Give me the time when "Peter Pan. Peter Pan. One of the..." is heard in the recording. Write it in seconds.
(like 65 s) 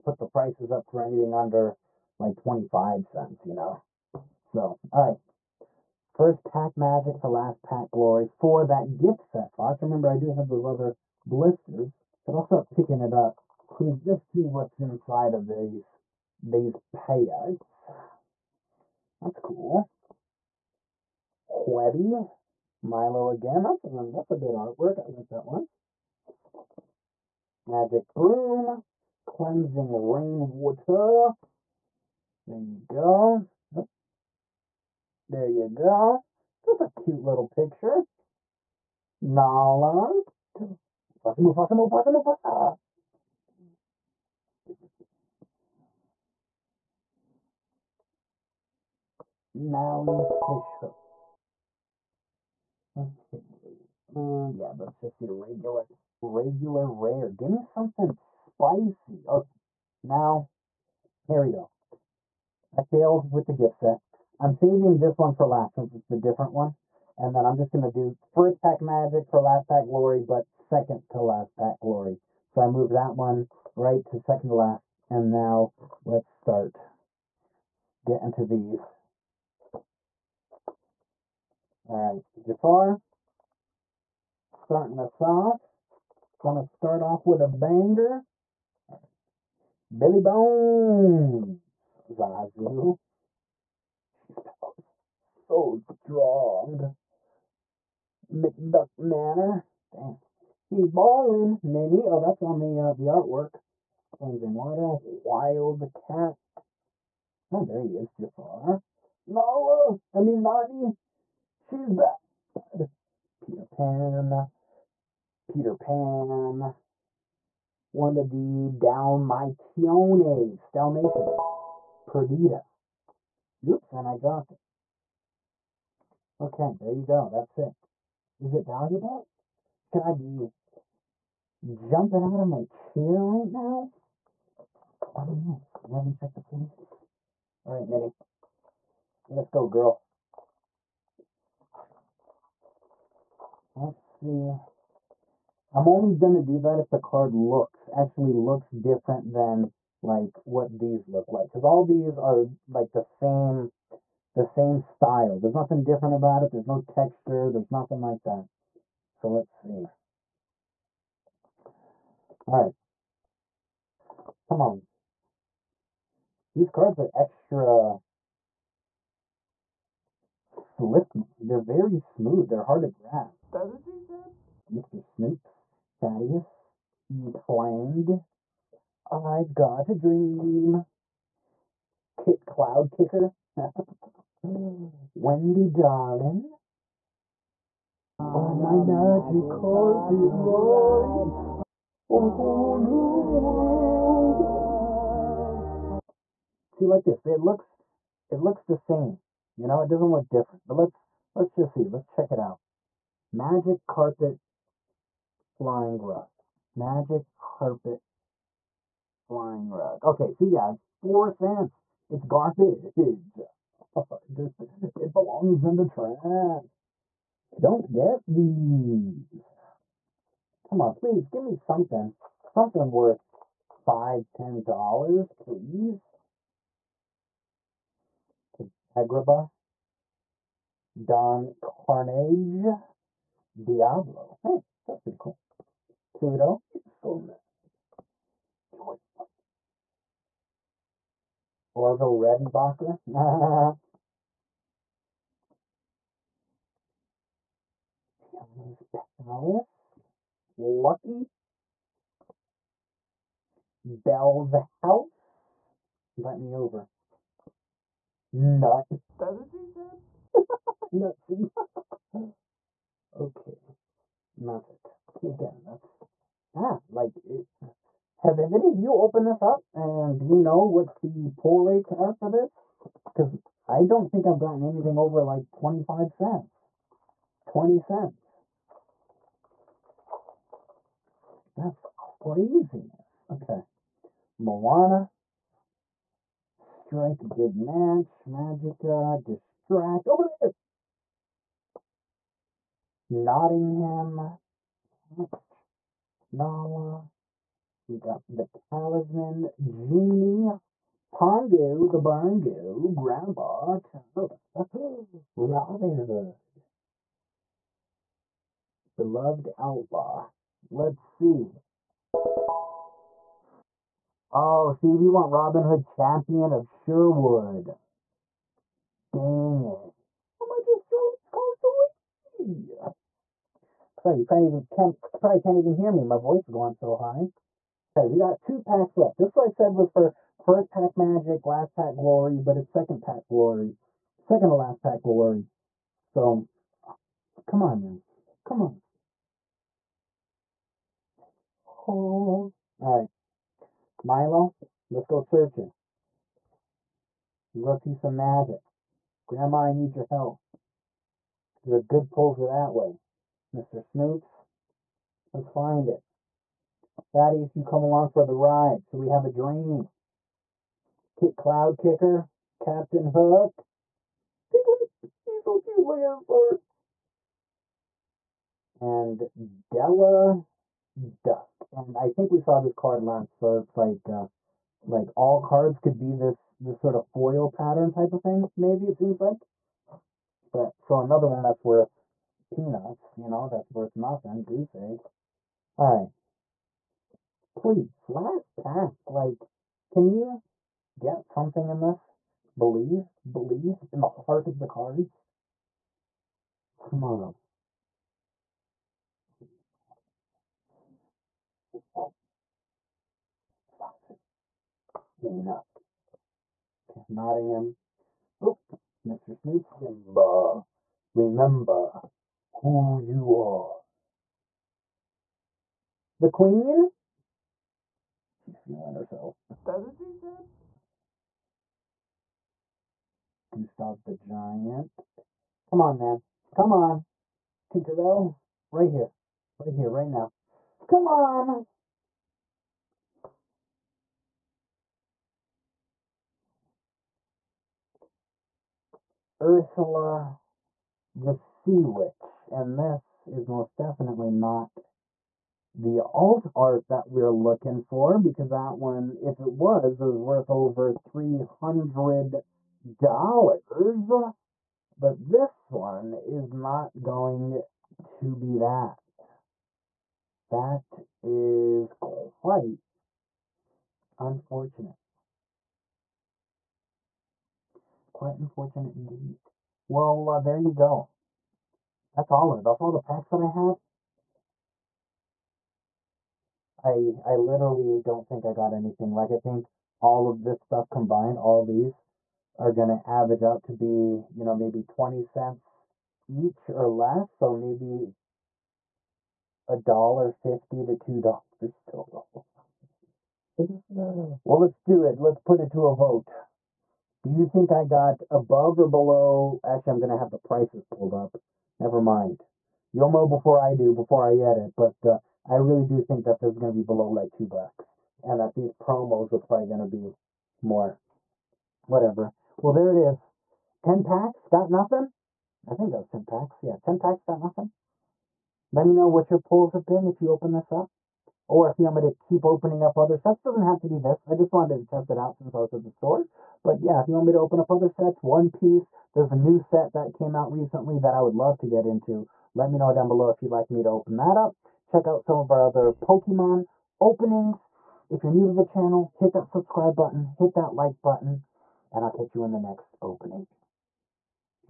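113 s.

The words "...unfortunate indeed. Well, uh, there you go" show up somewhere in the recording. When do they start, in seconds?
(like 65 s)
468 s.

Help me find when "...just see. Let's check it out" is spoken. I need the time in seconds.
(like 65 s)
201 s.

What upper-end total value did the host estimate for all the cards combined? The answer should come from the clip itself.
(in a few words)
2 dollars.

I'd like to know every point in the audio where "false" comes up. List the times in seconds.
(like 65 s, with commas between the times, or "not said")
not said.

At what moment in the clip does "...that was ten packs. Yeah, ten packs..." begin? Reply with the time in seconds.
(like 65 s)
515 s.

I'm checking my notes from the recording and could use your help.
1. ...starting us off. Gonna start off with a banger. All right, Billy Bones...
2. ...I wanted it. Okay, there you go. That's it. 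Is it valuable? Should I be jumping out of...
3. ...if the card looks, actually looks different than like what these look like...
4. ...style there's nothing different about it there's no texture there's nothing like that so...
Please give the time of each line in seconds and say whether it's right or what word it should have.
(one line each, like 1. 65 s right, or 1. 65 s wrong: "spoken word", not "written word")
1. 84 s right
2. 124 s wrong: "dropped", not "wanted"
3. 146 s right
4. 154 s right.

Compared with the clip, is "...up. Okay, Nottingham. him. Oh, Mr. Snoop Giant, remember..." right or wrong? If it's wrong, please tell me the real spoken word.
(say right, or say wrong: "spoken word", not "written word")
wrong: "Simba", not "Giant".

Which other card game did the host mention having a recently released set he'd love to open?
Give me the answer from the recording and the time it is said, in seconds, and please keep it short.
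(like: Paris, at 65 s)
One Piece, at 528 s.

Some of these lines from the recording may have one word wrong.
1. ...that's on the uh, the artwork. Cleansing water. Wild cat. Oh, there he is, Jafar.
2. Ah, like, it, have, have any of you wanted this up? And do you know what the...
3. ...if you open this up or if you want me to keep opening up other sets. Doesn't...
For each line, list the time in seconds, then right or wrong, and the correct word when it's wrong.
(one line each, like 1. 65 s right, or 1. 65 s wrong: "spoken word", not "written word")
1. 102 s right
2. 266 s wrong: "opened", not "wanted"
3. 520 s right.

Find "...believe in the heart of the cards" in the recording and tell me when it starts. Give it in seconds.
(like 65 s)
393 s.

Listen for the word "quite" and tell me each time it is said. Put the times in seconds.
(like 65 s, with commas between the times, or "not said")
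461 s, 468 s.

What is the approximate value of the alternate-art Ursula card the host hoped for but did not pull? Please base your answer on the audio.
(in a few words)
Over 300 dollars.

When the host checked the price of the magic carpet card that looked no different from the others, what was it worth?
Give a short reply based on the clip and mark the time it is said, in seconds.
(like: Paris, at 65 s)
4 cents, at 210 s.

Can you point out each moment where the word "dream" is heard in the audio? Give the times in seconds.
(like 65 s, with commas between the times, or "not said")
179 s, 359 s.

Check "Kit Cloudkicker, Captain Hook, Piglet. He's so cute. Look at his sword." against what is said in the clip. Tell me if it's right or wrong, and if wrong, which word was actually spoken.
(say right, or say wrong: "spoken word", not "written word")
right.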